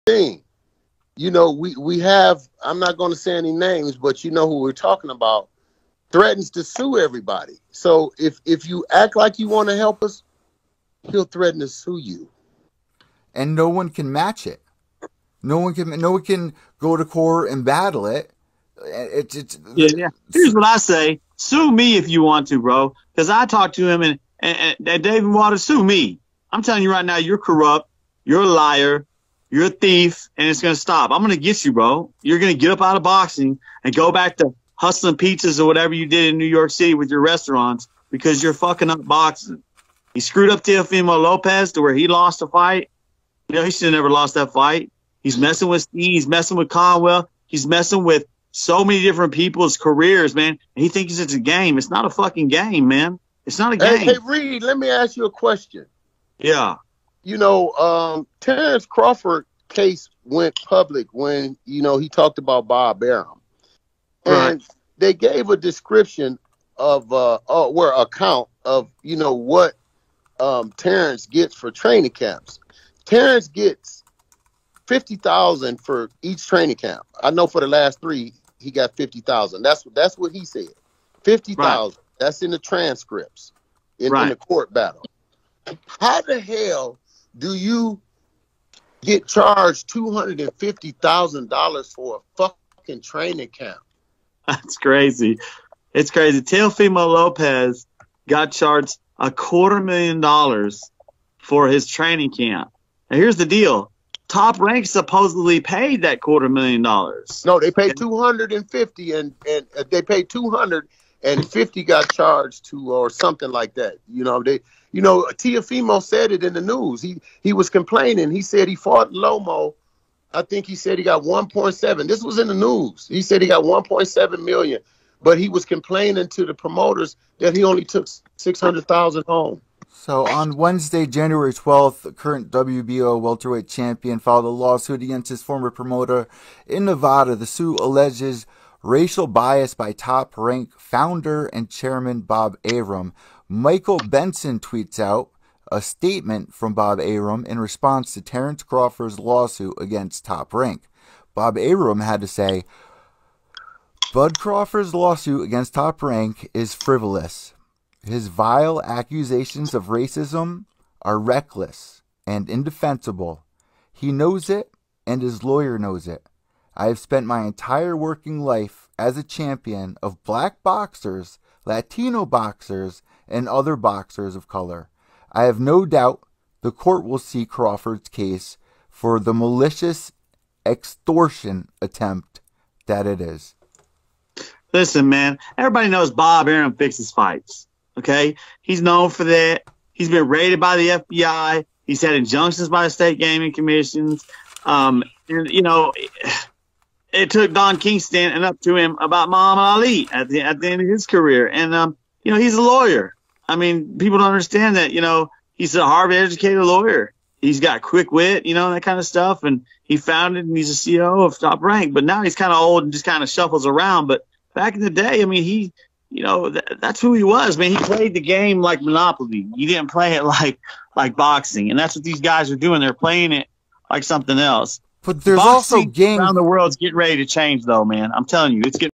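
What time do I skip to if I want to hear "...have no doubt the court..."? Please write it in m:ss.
2:55.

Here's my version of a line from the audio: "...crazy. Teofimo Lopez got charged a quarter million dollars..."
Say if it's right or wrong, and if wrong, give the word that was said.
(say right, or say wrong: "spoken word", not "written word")
right.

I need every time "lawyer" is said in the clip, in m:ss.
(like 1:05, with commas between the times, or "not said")
2:45, 3:22, 3:26.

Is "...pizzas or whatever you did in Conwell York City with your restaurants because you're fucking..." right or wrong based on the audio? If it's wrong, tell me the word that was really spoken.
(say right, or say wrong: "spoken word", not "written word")
wrong: "New", not "Conwell".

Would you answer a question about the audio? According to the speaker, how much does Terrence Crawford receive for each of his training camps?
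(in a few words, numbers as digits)
$50,000.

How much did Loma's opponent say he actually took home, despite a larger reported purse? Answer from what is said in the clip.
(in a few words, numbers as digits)
600,000.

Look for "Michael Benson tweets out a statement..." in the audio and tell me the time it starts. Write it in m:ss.
2:23.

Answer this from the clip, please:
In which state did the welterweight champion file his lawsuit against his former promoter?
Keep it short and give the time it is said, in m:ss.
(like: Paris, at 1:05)
Nevada, at 2:16.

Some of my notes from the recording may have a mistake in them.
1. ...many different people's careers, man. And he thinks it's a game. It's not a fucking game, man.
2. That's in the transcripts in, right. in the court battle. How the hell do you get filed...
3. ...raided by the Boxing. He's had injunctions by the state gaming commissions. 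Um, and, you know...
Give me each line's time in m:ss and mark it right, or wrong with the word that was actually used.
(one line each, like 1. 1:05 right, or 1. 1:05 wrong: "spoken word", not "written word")
1. 0:48 right
2. 1:22 wrong: "charged", not "filed"
3. 3:10 wrong: "FBI", not "Boxing".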